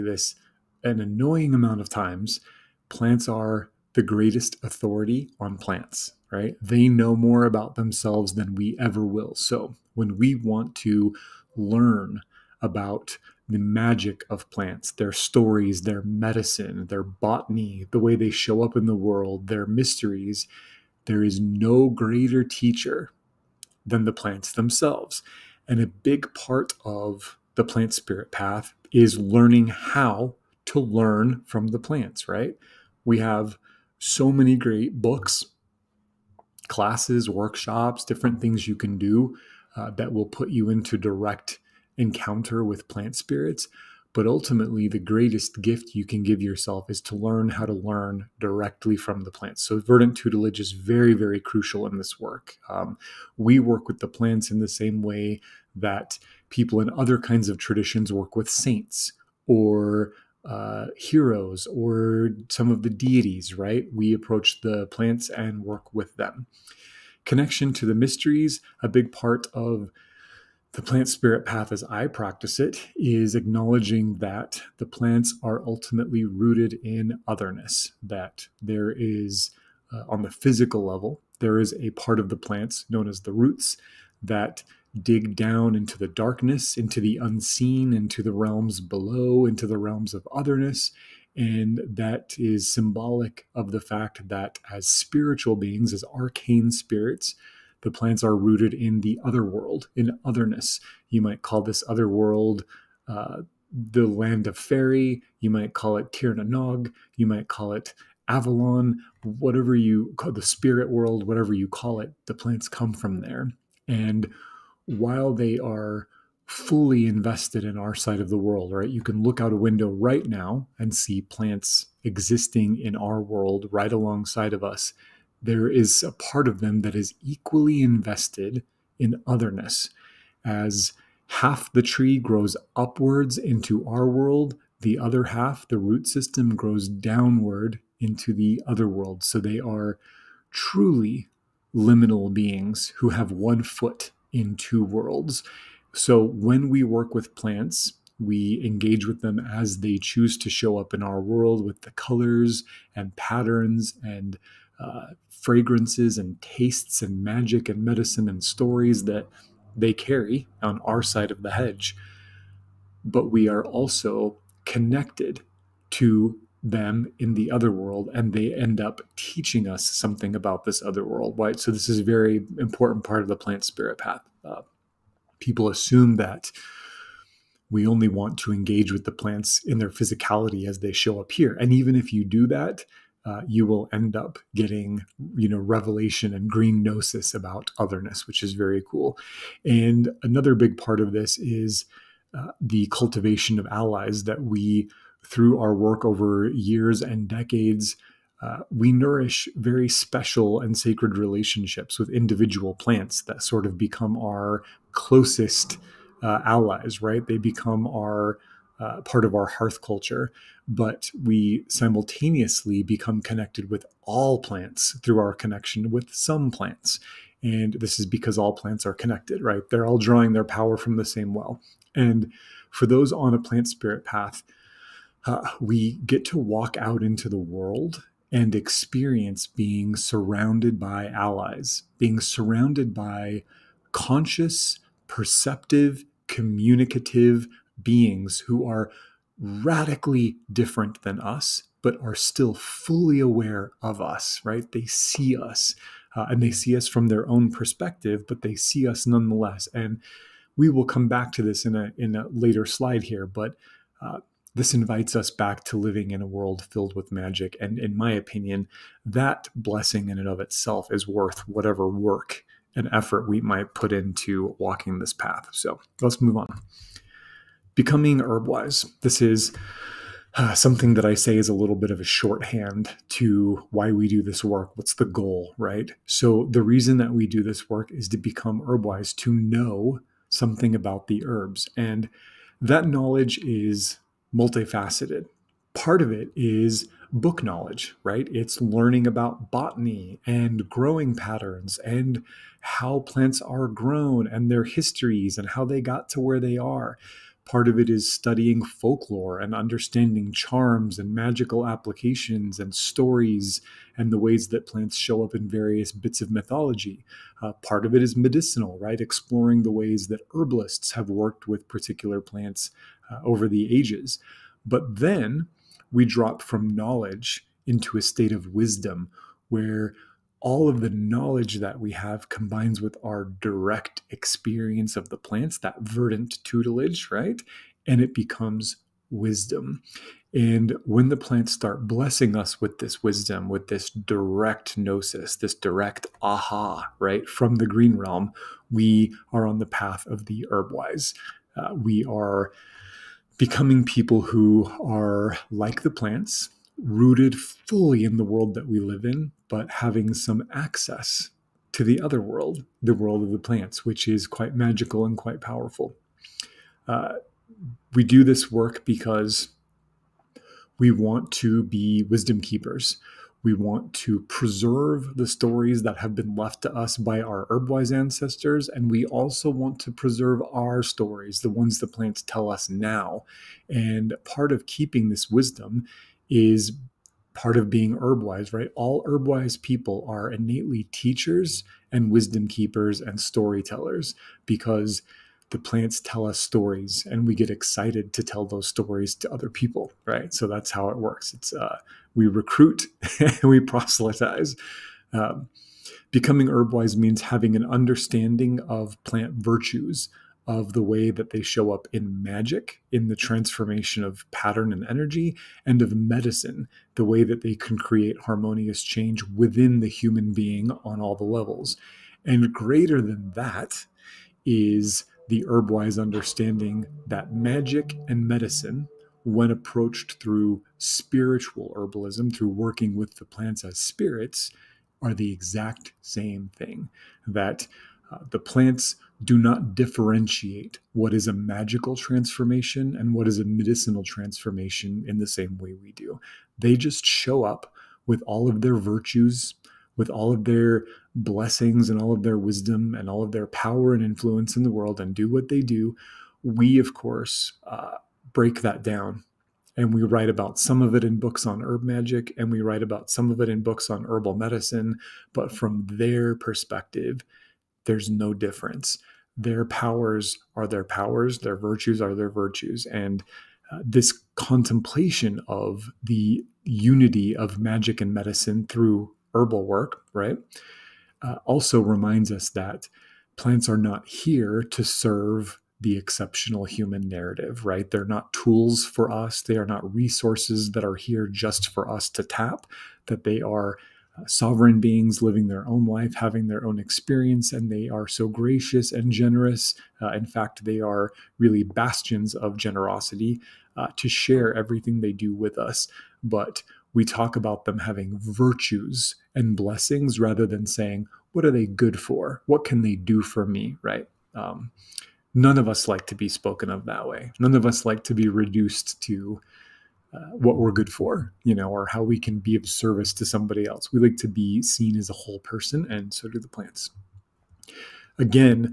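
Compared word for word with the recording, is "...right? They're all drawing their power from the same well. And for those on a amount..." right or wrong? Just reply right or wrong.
wrong.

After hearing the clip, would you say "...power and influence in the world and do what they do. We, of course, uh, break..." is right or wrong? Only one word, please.
right.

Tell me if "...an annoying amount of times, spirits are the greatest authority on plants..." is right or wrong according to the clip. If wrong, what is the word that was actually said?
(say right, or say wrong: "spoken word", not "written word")
wrong: "plants", not "spirits".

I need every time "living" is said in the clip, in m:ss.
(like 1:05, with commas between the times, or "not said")
4:15, 8:05.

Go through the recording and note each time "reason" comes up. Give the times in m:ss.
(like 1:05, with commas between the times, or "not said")
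4:36.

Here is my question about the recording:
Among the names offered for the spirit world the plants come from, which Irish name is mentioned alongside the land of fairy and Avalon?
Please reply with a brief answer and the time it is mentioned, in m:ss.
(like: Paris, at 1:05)
Tir na Nog, at 1:46.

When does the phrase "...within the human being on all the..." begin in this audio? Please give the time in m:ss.
6:49.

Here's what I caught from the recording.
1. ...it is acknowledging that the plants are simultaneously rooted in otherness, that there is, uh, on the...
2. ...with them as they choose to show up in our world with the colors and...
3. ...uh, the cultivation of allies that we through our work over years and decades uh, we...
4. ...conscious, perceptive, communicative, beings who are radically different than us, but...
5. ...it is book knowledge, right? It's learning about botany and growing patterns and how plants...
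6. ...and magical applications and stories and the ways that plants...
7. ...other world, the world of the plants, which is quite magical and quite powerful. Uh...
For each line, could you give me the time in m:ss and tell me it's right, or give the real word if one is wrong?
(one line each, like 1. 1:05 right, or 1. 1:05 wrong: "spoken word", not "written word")
1. 1:12 wrong: "ultimately", not "simultaneously"
2. 2:29 right
3. 3:12 right
4. 3:53 right
5. 4:46 right
6. 5:00 right
7. 5:52 right.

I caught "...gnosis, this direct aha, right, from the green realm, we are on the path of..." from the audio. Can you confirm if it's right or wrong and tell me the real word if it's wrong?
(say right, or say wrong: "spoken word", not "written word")
right.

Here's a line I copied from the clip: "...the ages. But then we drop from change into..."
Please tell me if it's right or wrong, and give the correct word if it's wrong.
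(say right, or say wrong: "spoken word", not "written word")
wrong: "knowledge", not "change".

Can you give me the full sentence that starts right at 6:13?
And part of keeping this wisdom is part of being herbwise, right?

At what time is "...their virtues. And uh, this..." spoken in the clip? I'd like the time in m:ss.
7:42.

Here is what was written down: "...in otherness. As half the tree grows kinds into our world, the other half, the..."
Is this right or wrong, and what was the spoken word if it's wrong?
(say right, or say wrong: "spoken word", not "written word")
wrong: "upwards", not "kinds".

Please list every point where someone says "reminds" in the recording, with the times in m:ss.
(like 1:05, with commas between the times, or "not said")
7:51.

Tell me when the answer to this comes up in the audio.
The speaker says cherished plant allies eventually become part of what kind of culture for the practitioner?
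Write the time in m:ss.
3:29.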